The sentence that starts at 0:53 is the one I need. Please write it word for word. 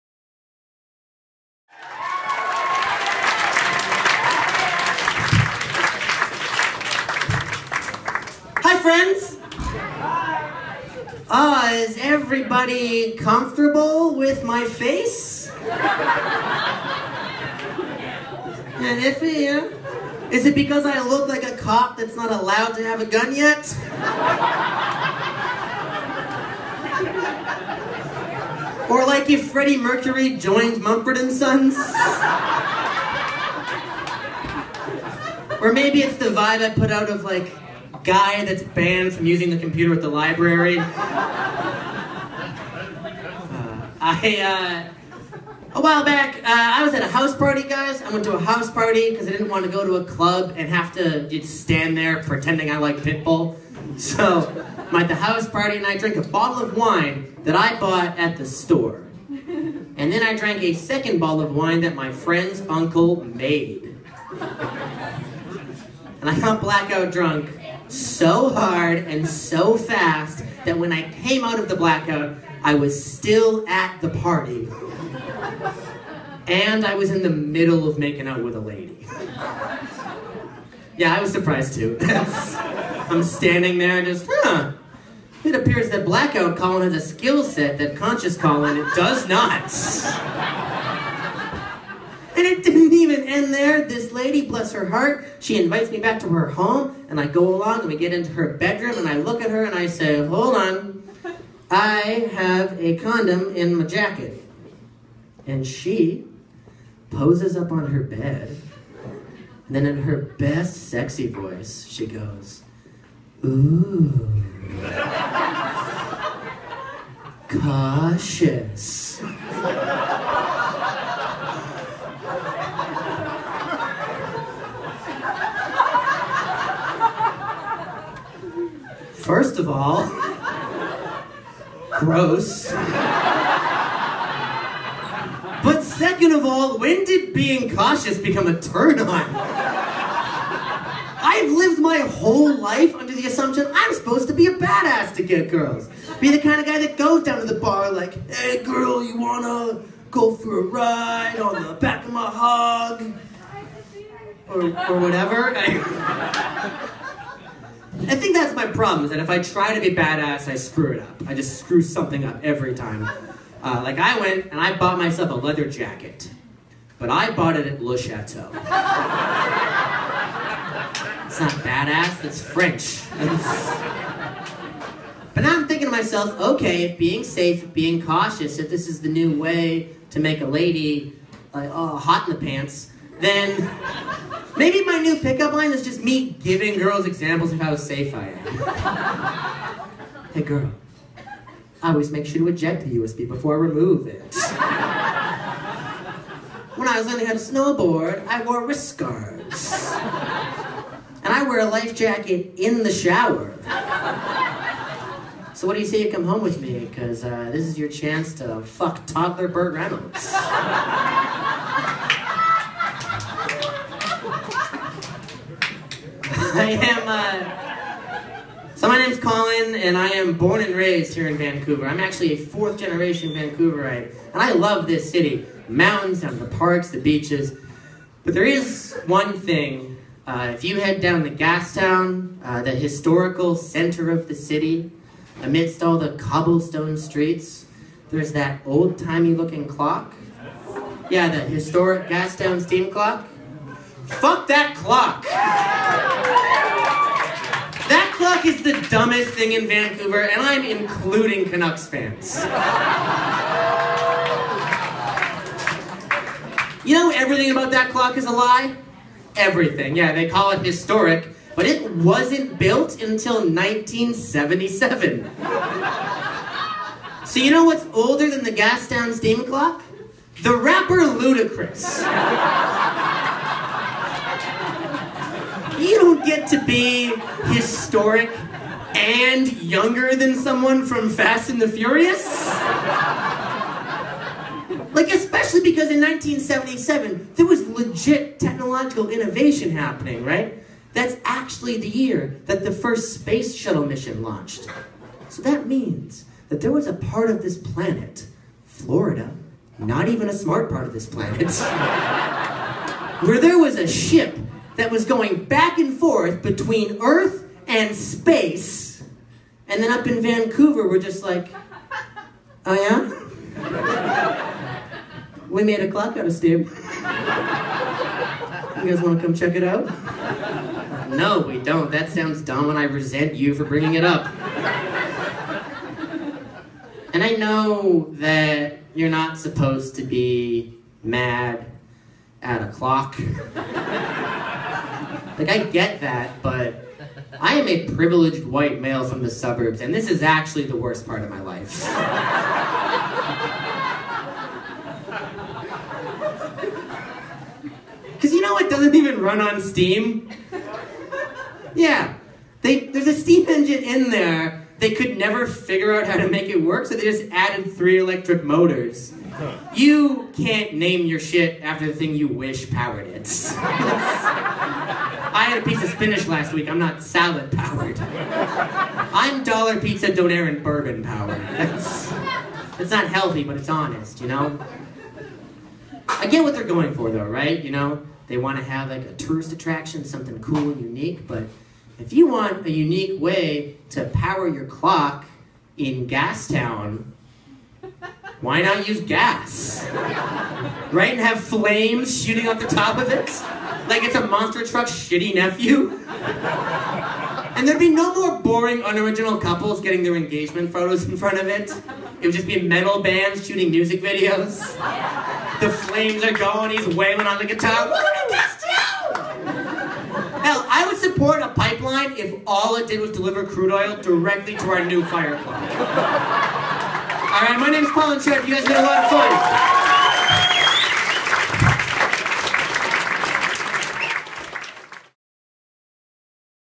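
So I'm at the house party and I drink a bottle of wine that I bought at the store.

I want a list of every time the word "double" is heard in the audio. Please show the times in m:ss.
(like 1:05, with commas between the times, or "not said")
not said.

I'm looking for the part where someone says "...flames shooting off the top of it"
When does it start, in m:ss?
6:31.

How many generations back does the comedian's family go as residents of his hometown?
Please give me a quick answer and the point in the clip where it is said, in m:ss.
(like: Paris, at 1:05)
Fourth generation, at 3:42.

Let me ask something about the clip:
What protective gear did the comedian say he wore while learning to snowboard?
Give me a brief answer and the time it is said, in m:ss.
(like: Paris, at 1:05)
Wrist guards, at 3:18.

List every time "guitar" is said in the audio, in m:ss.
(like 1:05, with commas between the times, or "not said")
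6:47.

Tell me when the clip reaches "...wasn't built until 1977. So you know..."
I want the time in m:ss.
4:21.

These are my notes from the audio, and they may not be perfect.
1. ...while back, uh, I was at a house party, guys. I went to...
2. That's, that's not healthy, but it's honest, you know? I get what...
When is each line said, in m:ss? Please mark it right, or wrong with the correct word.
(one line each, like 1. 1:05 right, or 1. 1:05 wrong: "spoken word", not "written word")
1. 0:45 right
2. 6:11 right.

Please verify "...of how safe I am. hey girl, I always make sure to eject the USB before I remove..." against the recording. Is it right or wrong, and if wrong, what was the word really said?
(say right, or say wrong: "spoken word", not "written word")
right.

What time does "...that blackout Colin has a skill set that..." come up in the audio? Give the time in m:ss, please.
1:25.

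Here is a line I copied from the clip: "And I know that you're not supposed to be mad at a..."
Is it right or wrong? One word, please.
right.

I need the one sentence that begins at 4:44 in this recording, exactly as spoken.
Like, especially because in 1977, there was legit technological innovation happening, right?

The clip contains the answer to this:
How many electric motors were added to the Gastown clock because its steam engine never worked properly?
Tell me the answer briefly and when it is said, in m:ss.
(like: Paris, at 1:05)
3, at 5:57.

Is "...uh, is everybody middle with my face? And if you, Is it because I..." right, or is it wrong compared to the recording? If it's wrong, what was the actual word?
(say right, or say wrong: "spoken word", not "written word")
wrong: "comfortable", not "middle".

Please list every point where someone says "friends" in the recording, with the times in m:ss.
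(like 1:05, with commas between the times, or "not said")
0:08, 1:02.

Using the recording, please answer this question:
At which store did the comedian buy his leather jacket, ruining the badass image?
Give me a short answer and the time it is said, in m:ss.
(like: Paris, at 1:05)
Le Chateau, at 2:47.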